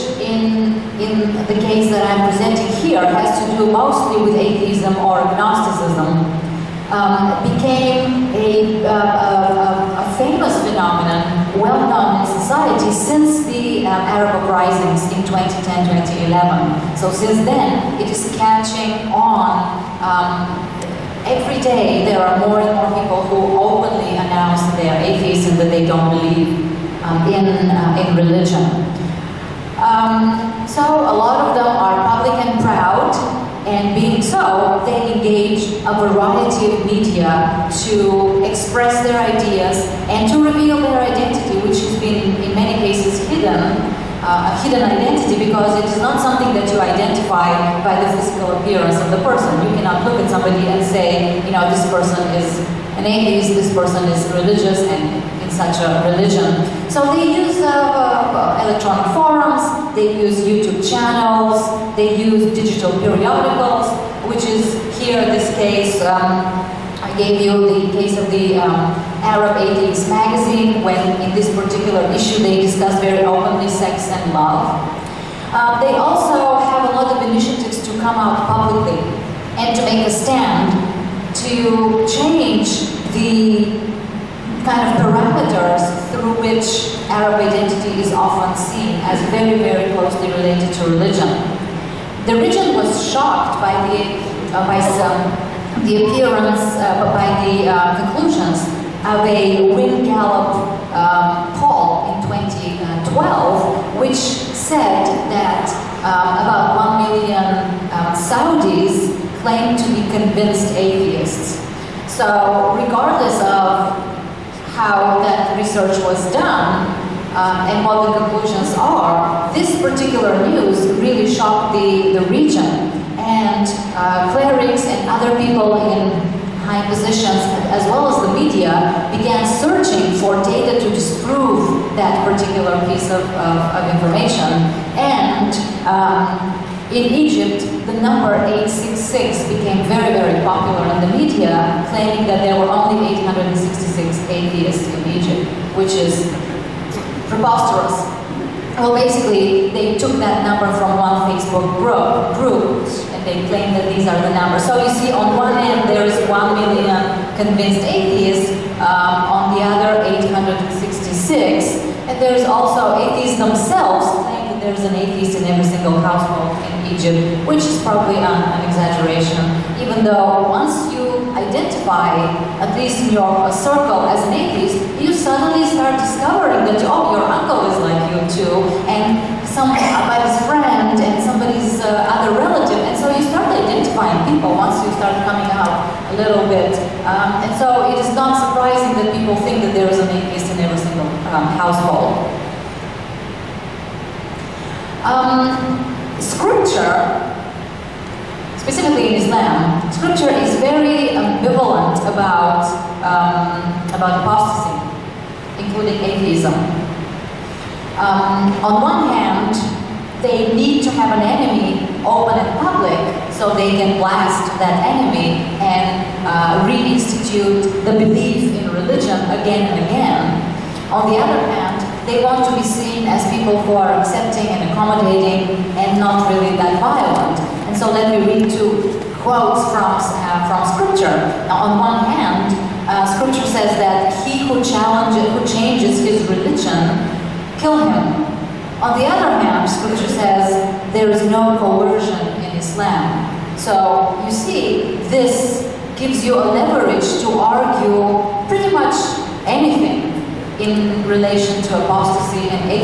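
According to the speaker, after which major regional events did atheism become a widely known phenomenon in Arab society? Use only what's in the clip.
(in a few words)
Arab uprisings.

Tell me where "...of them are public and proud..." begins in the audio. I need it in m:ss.
0:31.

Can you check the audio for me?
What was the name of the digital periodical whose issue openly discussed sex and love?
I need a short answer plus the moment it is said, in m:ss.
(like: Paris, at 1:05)
Arab Atheist magazine, at 1:09.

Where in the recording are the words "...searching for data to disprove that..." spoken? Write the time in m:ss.
2:09.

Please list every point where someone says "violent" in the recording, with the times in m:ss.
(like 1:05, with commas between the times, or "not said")
3:46.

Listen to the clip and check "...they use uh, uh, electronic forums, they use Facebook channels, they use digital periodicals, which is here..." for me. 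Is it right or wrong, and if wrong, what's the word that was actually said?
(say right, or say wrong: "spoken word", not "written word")
wrong: "YouTube", not "Facebook".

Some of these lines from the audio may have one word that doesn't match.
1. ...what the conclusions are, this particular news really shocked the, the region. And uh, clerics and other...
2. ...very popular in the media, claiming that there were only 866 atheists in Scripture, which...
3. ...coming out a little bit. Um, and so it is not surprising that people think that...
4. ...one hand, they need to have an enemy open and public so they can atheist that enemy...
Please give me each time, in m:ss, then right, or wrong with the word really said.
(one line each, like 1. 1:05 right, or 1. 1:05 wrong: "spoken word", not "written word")
1. 1:57 right
2. 2:20 wrong: "Egypt", not "Scripture"
3. 3:05 right
4. 3:28 wrong: "blast", not "atheist".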